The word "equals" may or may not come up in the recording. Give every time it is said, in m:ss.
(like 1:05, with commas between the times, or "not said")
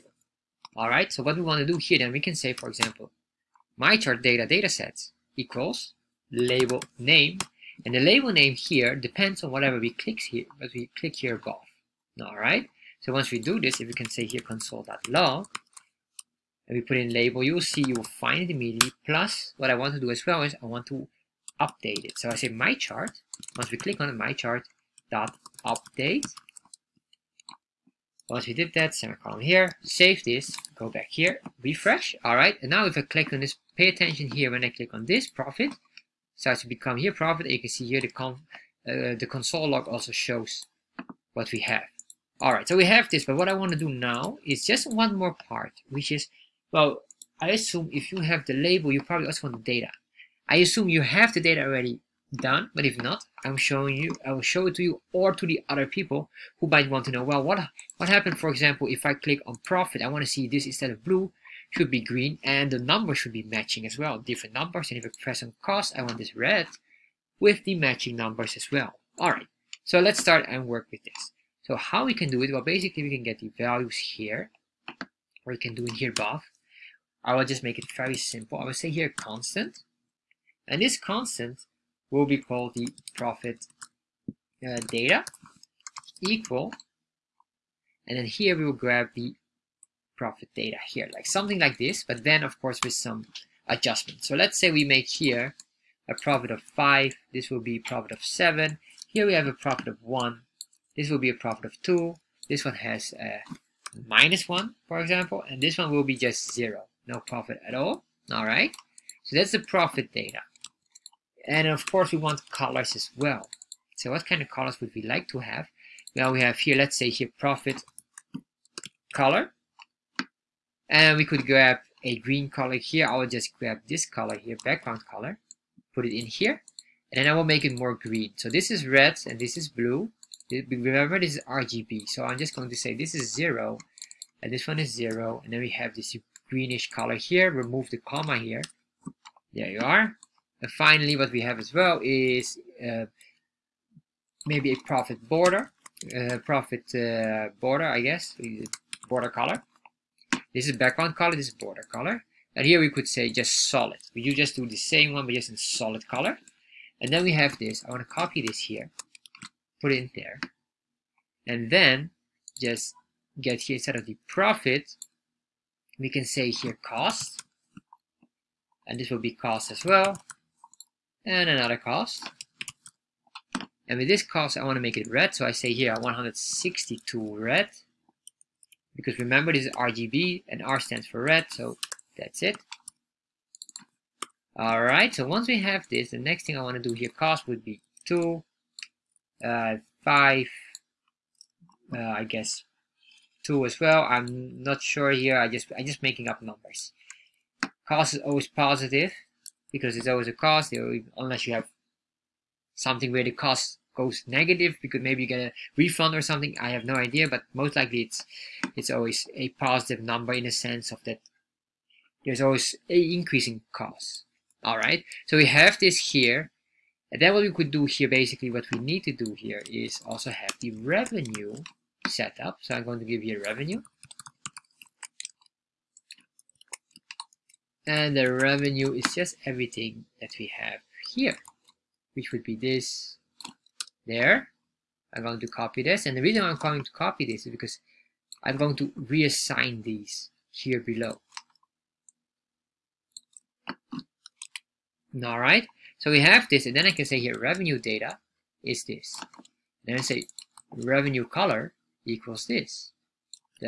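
0:05, 1:26, 4:12.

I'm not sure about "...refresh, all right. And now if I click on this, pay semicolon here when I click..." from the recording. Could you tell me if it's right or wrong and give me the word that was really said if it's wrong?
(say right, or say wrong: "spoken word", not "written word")
wrong: "attention", not "semicolon".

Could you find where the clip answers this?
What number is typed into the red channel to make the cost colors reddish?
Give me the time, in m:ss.
2:55.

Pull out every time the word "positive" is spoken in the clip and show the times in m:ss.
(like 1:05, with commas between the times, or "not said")
3:18, 3:29.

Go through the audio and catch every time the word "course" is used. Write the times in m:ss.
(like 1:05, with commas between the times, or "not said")
1:32, 1:51.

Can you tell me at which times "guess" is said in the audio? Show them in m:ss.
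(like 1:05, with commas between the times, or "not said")
2:27, 3:12.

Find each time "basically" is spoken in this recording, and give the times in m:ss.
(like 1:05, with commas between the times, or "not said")
1:12, 3:38.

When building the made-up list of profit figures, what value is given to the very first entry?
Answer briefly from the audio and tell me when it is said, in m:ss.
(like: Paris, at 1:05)
5, at 1:36.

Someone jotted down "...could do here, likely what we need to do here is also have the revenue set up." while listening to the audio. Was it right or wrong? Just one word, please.
wrong.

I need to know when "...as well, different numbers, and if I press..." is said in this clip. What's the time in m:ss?
1:03.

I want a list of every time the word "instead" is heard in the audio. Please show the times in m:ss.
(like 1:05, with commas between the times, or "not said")
1:00, 2:43.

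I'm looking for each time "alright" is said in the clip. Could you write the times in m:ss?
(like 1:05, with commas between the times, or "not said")
3:04, 4:05.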